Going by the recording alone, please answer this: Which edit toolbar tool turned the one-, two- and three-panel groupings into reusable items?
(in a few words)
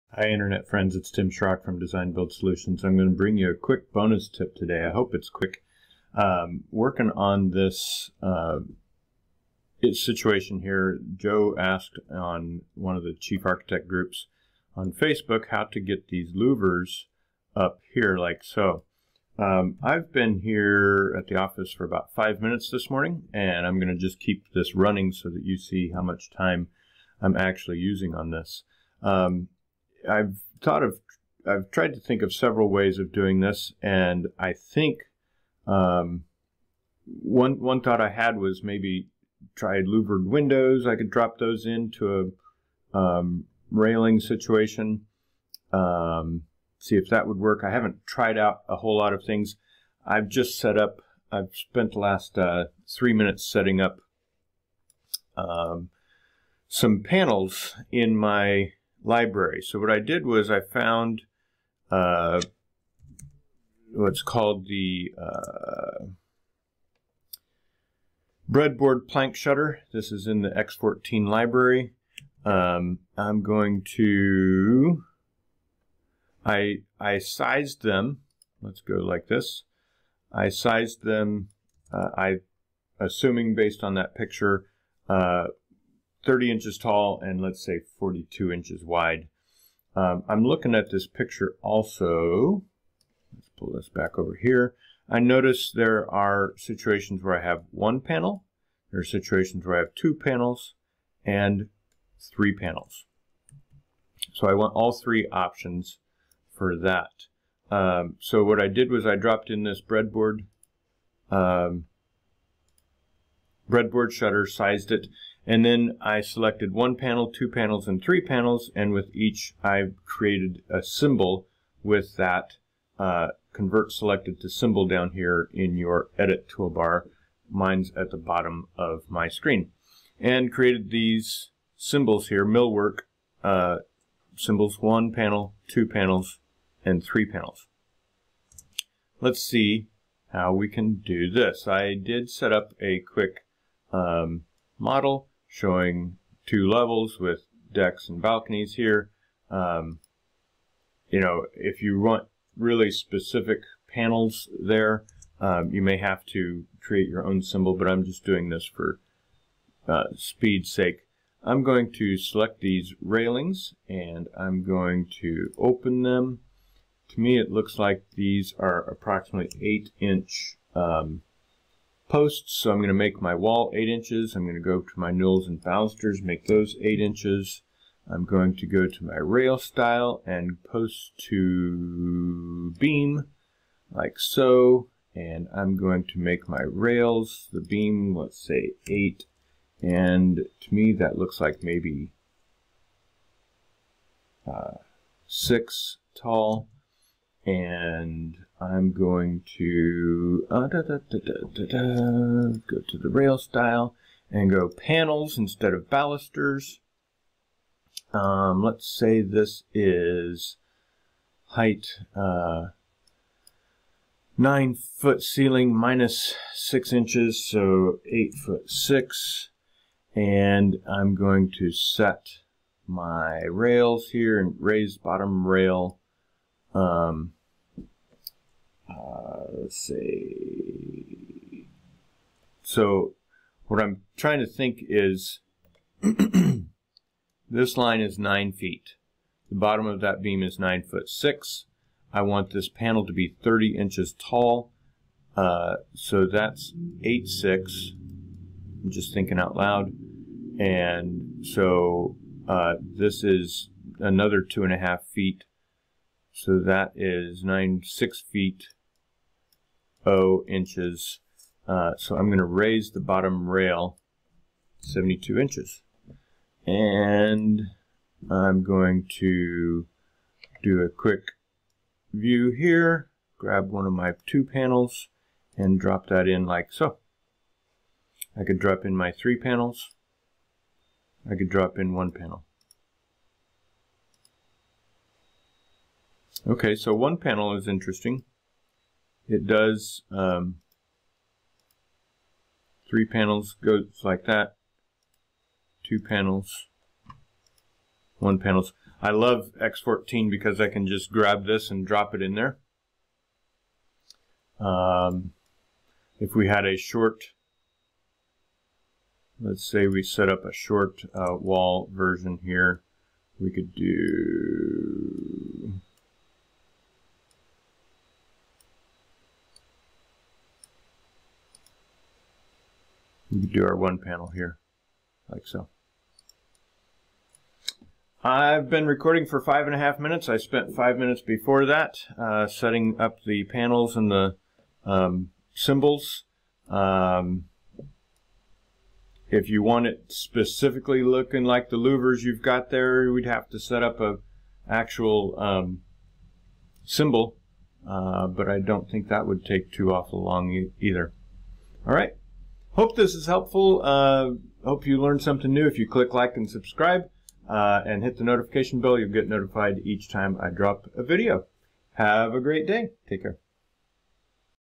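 convert selected to symbol.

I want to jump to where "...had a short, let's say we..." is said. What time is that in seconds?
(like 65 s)
306 s.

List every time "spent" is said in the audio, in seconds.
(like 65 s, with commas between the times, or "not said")
51 s, 330 s.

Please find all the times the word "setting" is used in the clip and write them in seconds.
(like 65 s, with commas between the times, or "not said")
53 s, 332 s.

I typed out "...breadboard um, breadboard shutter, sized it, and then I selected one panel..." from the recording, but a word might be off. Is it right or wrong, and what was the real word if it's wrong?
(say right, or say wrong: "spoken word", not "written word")
right.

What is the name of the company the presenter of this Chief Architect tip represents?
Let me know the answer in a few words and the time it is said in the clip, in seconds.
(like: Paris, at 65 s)
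Design Build Solutions, at 1 s.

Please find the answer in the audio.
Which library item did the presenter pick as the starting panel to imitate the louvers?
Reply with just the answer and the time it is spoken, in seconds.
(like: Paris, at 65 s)
breadboard plank shutter, at 68 s.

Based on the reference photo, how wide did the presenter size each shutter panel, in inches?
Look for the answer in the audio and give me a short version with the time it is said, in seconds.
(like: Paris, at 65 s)
42, at 87 s.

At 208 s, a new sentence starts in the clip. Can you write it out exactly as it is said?
Um, let's say this is height uh, 9 foot ceiling minus 6 inches, so 8 foot 6.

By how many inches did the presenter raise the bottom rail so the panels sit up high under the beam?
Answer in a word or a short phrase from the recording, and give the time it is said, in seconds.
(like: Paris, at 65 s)
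72, at 264 s.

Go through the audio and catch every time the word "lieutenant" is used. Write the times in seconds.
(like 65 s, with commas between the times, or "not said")
not said.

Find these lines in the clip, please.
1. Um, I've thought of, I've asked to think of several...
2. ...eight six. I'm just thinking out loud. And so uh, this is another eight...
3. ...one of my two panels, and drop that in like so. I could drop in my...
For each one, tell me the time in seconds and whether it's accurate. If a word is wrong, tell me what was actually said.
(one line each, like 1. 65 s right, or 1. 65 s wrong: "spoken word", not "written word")
1. 29 s wrong: "tried", not "asked"
2. 247 s wrong: "two", not "eight"
3. 273 s right.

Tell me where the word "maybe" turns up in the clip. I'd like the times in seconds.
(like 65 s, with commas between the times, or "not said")
38 s, 191 s.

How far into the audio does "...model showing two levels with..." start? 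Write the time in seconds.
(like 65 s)
144 s.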